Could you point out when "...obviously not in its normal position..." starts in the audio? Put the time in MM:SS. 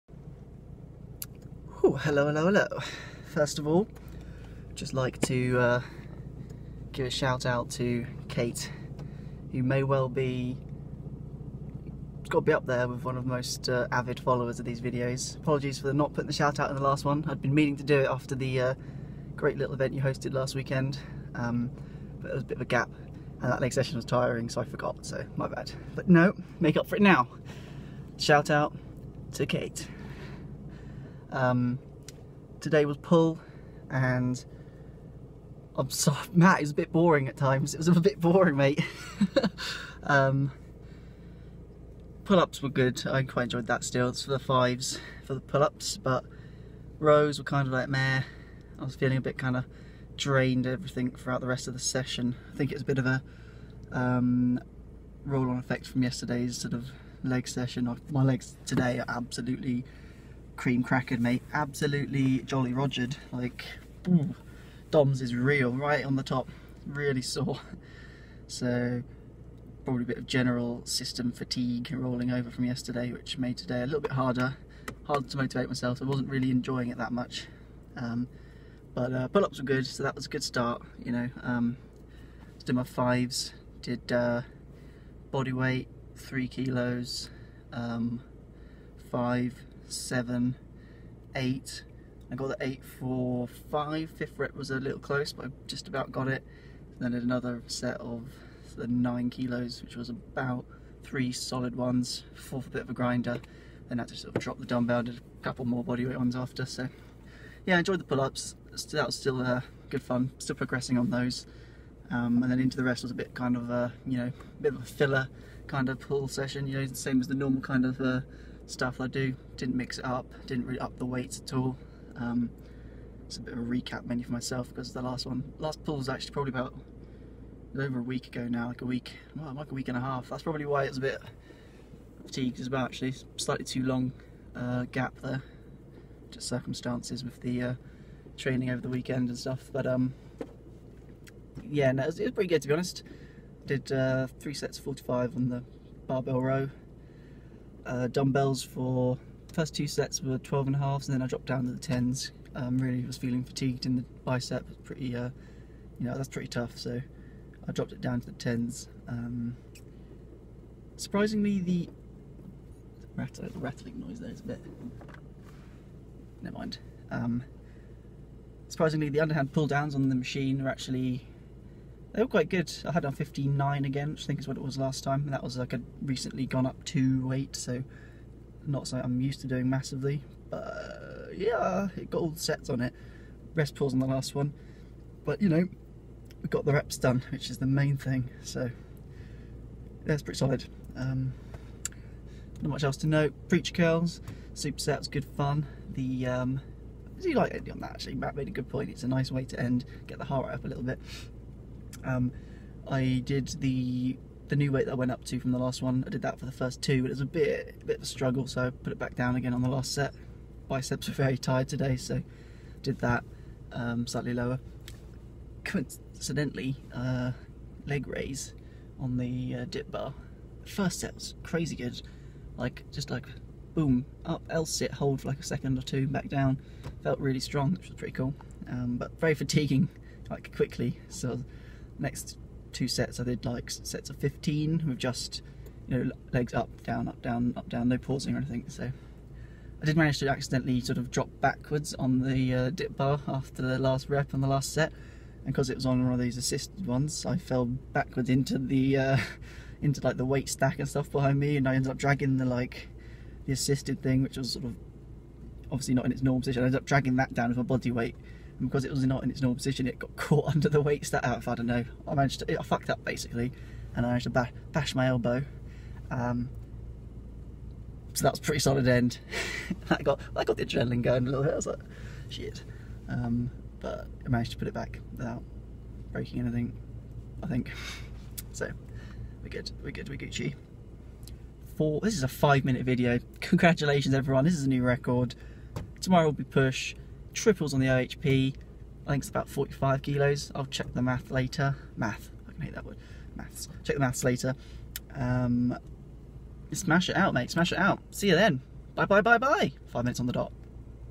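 04:15.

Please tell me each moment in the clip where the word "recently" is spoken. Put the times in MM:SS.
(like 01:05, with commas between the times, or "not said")
02:56.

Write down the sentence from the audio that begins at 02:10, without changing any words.
That's probably why it's a bit fatigued as well actually, slightly too long uh, gap there.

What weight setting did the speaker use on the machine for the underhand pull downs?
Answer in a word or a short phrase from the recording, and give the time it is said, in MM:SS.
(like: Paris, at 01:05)
59, at 02:53.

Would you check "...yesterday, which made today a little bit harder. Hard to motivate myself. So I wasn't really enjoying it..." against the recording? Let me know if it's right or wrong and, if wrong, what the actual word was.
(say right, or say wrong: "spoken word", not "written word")
right.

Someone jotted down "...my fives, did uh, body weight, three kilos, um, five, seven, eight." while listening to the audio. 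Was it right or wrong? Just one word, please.
right.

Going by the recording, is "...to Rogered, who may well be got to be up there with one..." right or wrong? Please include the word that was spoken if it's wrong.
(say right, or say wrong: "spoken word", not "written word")
wrong: "Kate", not "Rogered".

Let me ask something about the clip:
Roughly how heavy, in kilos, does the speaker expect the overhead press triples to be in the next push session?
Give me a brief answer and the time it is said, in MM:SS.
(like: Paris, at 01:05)
45, at 04:49.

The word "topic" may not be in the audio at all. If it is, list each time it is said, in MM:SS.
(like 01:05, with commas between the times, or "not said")
not said.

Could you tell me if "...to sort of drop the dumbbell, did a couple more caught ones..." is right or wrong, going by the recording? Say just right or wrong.
wrong.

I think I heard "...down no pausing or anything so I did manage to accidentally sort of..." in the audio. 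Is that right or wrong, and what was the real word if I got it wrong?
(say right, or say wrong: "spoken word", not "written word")
right.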